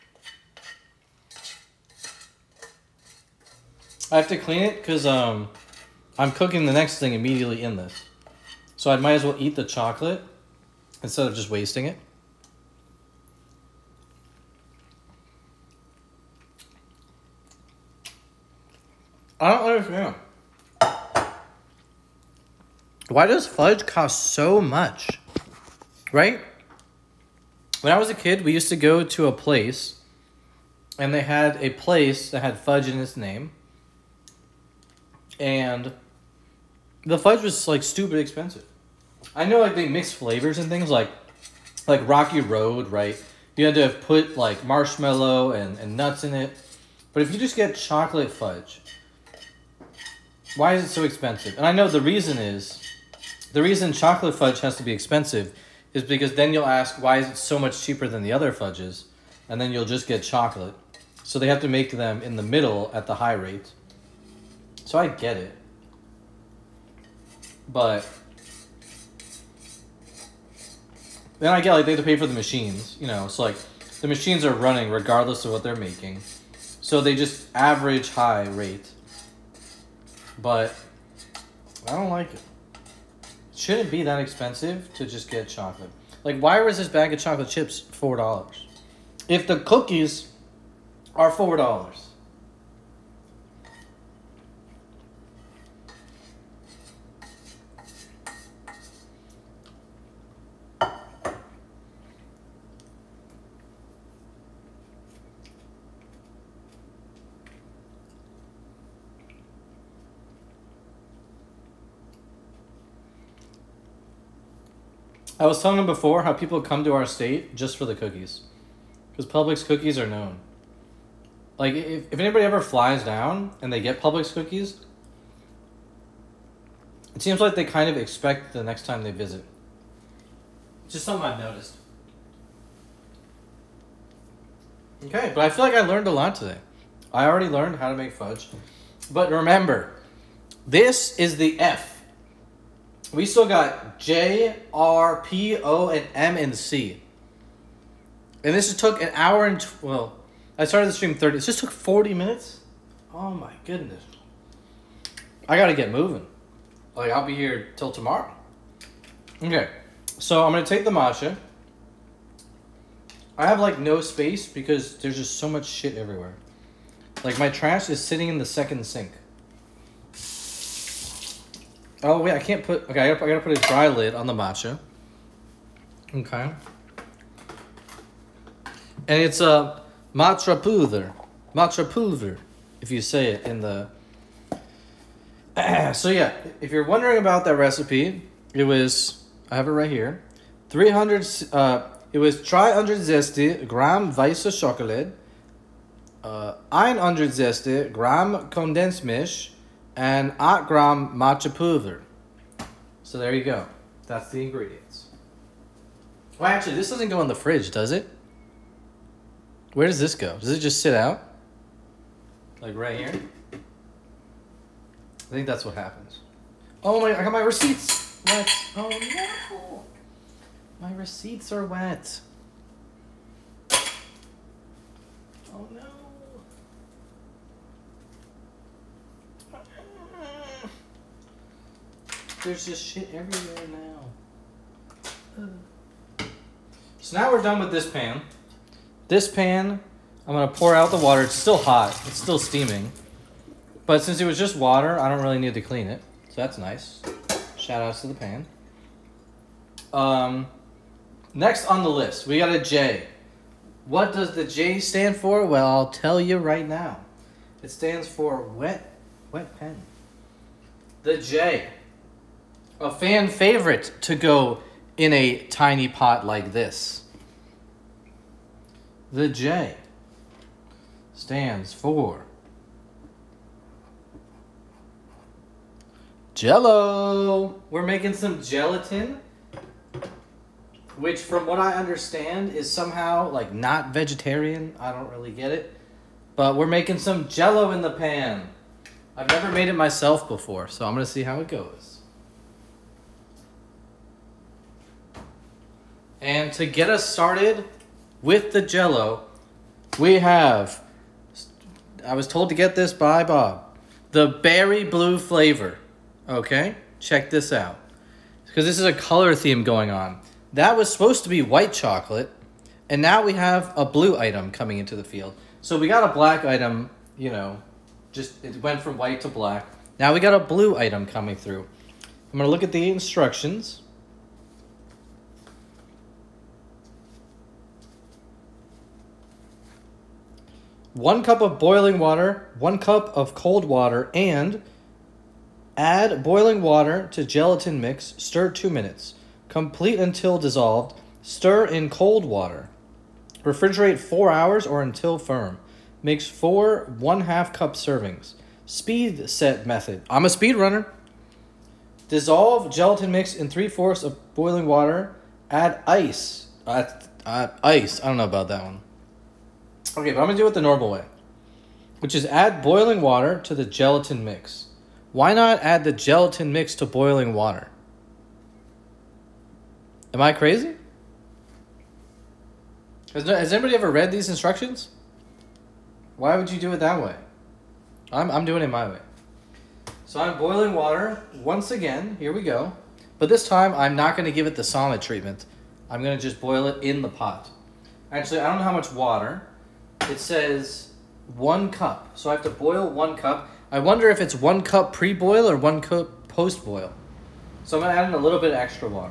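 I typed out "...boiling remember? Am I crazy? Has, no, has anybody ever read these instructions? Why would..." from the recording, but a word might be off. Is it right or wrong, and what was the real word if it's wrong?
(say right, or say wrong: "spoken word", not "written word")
wrong: "water", not "remember".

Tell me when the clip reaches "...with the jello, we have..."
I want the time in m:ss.
4:58.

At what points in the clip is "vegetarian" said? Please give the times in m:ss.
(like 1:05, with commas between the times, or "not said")
4:43.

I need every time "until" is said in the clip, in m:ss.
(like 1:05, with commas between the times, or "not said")
5:39, 5:44.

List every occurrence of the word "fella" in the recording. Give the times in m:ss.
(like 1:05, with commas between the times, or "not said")
not said.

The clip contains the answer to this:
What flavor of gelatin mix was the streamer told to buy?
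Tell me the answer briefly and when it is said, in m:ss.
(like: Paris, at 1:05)
Berry blue, at 5:04.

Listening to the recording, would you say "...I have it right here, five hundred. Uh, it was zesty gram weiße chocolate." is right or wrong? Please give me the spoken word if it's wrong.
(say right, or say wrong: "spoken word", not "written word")
wrong: "three", not "five".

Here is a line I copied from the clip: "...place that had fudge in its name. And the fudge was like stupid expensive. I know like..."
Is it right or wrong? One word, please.
right.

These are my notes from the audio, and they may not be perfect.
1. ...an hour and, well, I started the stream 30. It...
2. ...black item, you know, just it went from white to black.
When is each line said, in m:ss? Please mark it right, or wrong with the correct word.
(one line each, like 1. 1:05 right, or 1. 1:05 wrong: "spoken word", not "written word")
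1. 2:29 right
2. 5:16 right.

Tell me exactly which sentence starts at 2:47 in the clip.
Like my trash is sitting in the second sink.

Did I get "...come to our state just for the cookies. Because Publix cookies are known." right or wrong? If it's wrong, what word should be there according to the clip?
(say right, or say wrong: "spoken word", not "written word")
right.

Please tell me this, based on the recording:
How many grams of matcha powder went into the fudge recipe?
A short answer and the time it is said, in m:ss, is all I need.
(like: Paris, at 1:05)
8 grams, at 3:20.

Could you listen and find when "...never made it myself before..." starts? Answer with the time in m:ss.
4:49.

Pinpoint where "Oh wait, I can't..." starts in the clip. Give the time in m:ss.
2:52.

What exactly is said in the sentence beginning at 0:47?
But if you just get chocolate fudge, why is it so expensive?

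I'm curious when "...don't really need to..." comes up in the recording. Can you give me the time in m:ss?
4:05.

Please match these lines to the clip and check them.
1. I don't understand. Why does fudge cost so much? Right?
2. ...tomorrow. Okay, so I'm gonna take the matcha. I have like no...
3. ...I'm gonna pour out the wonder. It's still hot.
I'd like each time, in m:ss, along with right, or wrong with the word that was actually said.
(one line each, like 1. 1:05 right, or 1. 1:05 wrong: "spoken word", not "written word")
1. 0:19 right
2. 2:37 right
3. 4:00 wrong: "water", not "wonder".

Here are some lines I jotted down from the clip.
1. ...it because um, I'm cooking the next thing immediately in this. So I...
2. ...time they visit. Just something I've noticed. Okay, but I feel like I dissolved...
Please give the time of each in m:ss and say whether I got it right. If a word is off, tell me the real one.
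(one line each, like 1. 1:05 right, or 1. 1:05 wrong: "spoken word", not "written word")
1. 0:04 right
2. 2:08 wrong: "learned", not "dissolved".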